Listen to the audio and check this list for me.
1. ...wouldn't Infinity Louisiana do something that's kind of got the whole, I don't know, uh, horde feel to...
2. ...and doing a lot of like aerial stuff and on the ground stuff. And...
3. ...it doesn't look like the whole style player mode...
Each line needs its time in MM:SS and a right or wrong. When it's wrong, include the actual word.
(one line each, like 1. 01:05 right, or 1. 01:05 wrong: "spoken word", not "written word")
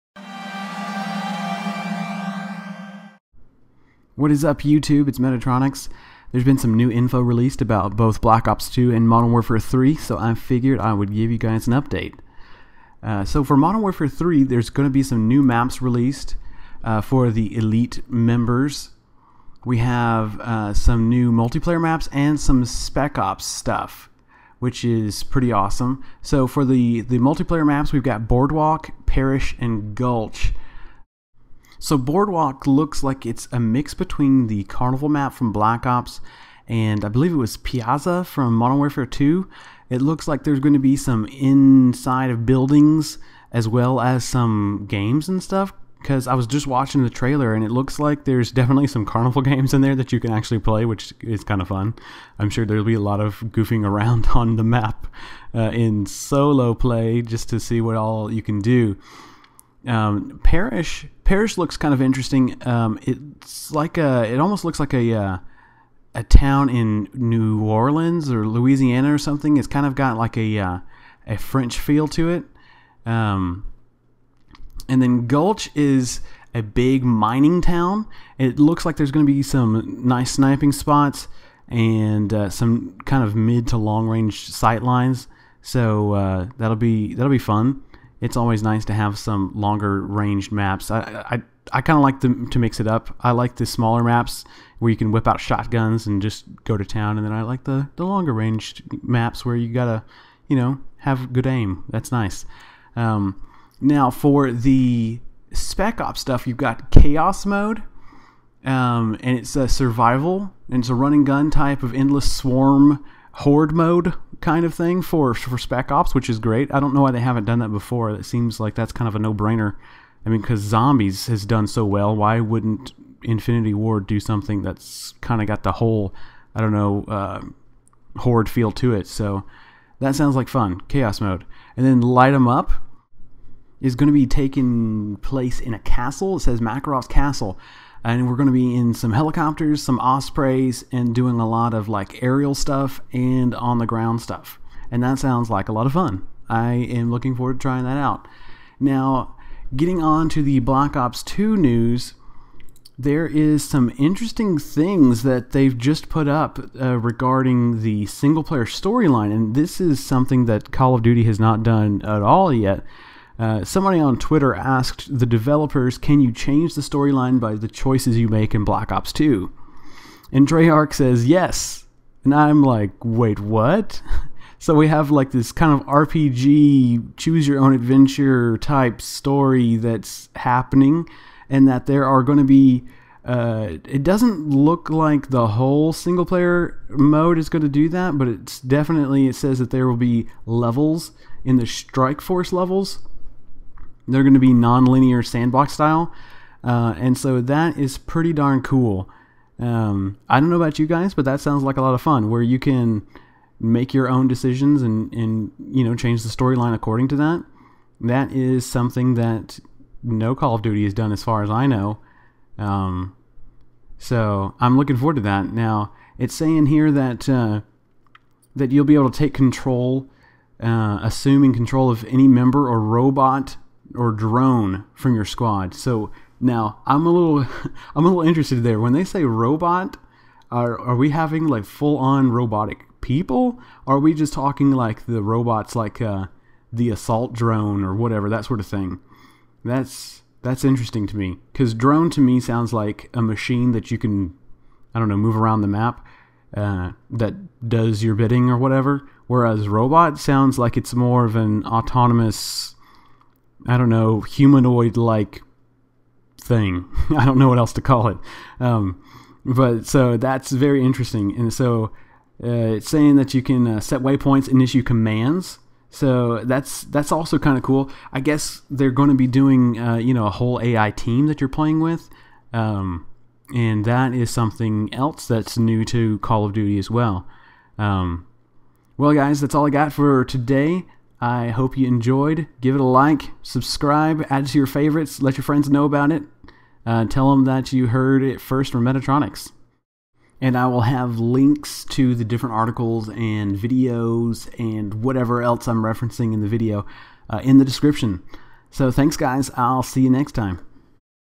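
1. 02:02 wrong: "Ward", not "Louisiana"
2. 02:20 right
3. 03:03 wrong: "single", not "style".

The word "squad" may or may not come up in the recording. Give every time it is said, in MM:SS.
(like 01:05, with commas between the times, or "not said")
03:45.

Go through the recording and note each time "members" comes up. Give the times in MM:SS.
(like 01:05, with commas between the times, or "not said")
00:18, 03:42.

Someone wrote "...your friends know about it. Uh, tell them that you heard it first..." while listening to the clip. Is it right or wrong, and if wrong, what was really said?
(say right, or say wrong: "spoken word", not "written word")
right.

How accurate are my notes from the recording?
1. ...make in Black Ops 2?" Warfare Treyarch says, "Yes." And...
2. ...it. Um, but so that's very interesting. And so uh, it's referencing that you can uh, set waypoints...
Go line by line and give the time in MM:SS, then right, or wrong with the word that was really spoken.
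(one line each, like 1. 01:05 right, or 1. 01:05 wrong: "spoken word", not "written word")
1. 02:48 wrong: "And", not "Warfare"
2. 04:18 wrong: "saying", not "referencing".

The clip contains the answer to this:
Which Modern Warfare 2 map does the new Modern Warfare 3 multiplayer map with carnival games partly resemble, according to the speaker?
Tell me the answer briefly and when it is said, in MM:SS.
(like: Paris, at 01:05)
Piazza, at 00:37.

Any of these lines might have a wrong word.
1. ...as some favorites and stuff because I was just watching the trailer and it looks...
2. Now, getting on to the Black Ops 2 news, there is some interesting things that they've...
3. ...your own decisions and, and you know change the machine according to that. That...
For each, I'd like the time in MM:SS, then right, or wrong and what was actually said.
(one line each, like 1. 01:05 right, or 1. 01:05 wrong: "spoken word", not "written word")
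1. 00:43 wrong: "games", not "favorites"
2. 02:28 right
3. 03:23 wrong: "storyline", not "machine".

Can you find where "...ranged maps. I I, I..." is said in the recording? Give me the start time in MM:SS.
01:30.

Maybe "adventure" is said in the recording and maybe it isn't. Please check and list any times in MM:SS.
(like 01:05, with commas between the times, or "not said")
02:57.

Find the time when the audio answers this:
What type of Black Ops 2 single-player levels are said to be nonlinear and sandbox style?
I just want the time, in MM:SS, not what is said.
03:11.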